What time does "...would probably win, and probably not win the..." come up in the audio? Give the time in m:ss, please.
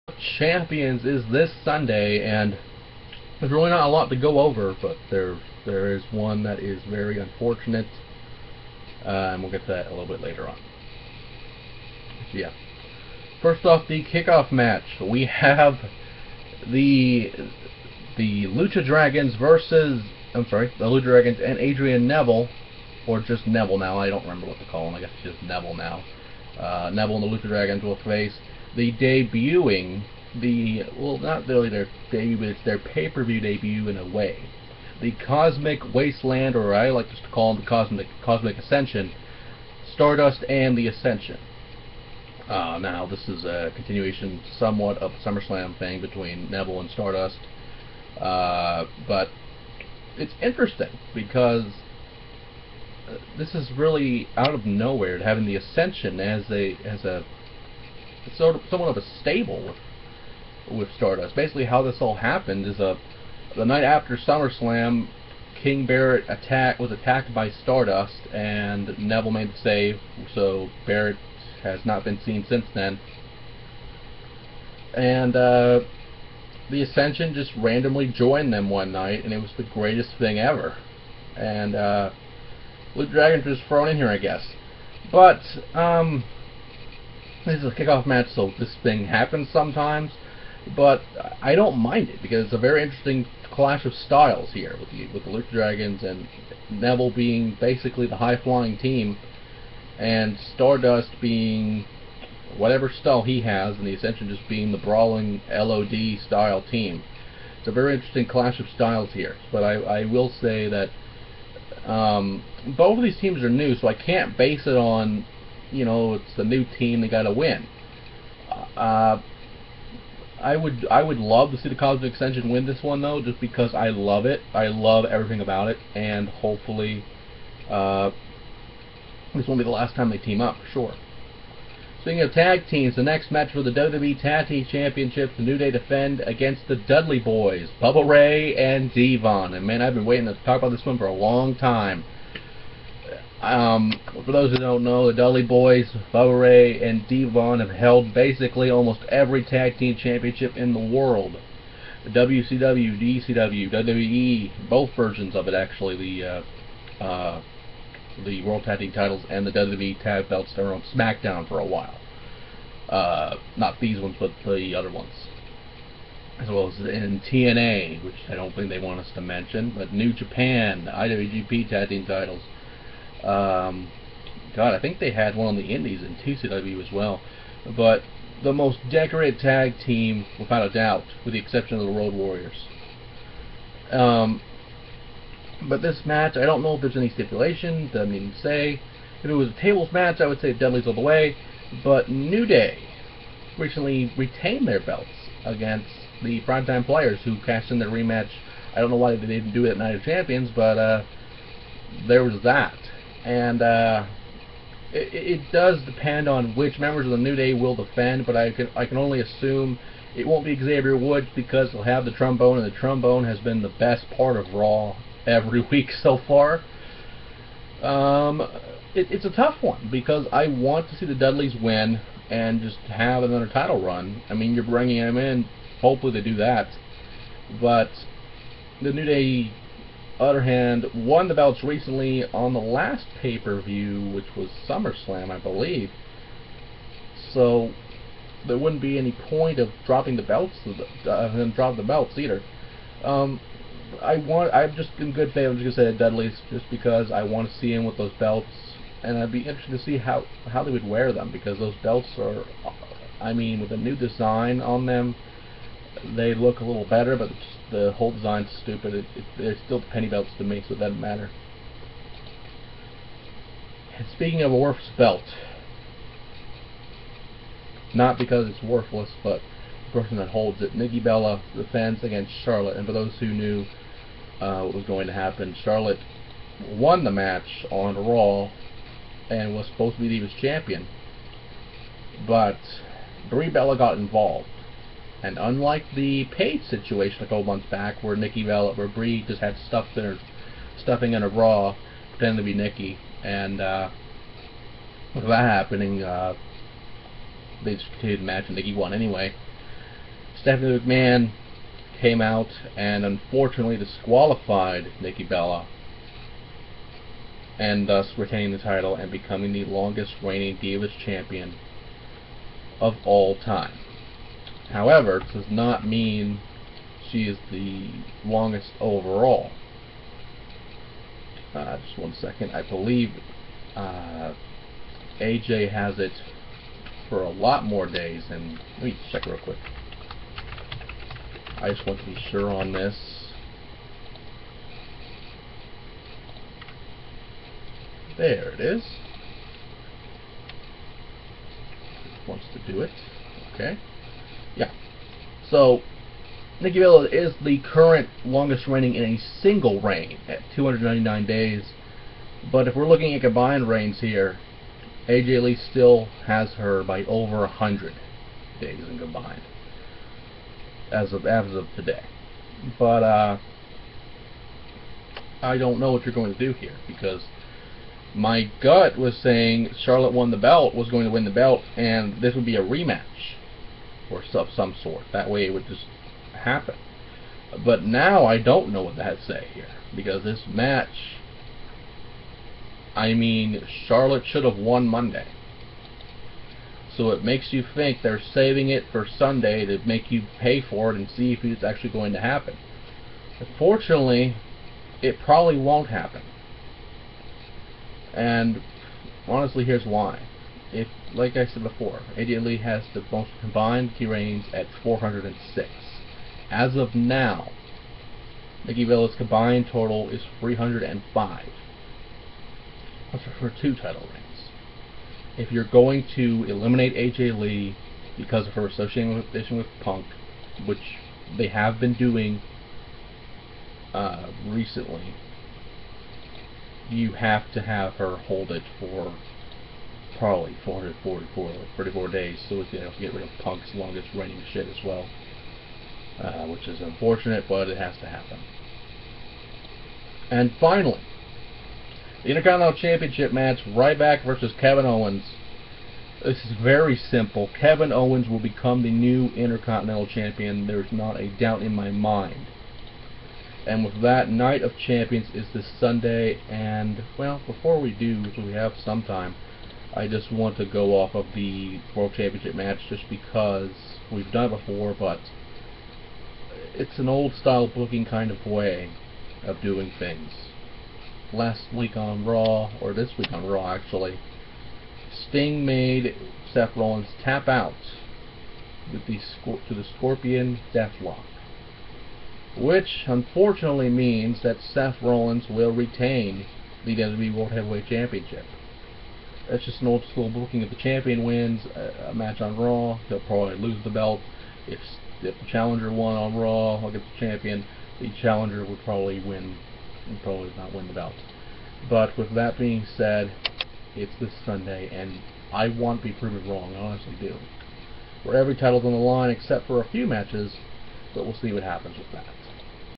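8:18.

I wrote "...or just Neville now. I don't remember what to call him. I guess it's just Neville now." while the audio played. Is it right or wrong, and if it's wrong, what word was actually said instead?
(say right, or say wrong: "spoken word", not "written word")
right.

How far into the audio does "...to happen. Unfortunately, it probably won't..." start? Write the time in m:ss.
6:32.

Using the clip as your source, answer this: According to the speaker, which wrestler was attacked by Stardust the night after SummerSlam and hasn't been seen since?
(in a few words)
King Barrett.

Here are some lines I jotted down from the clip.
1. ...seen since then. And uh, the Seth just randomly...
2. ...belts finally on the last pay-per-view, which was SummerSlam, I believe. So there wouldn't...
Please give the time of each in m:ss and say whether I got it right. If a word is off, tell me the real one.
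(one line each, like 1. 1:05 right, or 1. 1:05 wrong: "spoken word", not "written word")
1. 1:12 wrong: "Ascension", not "Seth"
2. 3:51 wrong: "recently", not "finally".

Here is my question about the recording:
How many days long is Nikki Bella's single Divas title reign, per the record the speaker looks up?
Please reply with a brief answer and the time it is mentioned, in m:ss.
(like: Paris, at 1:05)
299 days, at 5:50.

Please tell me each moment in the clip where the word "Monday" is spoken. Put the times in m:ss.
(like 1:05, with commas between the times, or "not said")
6:24.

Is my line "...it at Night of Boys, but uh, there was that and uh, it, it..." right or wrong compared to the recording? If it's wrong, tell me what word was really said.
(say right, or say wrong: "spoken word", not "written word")
wrong: "Champions", not "Boys".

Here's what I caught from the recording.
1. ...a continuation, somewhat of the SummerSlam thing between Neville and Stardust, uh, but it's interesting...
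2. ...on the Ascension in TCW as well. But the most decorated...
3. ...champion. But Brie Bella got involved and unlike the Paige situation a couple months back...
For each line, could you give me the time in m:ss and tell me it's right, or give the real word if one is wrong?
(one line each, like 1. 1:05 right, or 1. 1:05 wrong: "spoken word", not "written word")
1. 0:43 right
2. 2:55 wrong: "Indies", not "Ascension"
3. 4:40 right.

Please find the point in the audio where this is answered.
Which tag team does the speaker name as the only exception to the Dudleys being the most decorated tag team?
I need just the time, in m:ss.
3:01.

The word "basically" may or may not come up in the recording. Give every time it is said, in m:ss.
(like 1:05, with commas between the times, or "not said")
1:01, 1:37, 2:28.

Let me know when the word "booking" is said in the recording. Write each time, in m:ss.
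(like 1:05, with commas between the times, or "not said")
7:47, 8:10.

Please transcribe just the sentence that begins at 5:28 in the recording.
And let me check real quick.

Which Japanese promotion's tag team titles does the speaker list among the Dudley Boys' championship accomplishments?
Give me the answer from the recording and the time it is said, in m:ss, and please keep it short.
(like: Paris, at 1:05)
New Japan, at 2:49.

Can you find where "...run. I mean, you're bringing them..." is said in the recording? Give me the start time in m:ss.
3:43.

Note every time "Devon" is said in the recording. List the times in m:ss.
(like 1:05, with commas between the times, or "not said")
2:18, 2:27.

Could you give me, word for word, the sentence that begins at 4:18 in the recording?
It, it, they're still penny belts to me, so it doesn't matter.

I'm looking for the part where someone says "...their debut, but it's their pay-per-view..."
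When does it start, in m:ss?
0:31.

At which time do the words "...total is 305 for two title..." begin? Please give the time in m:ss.
6:49.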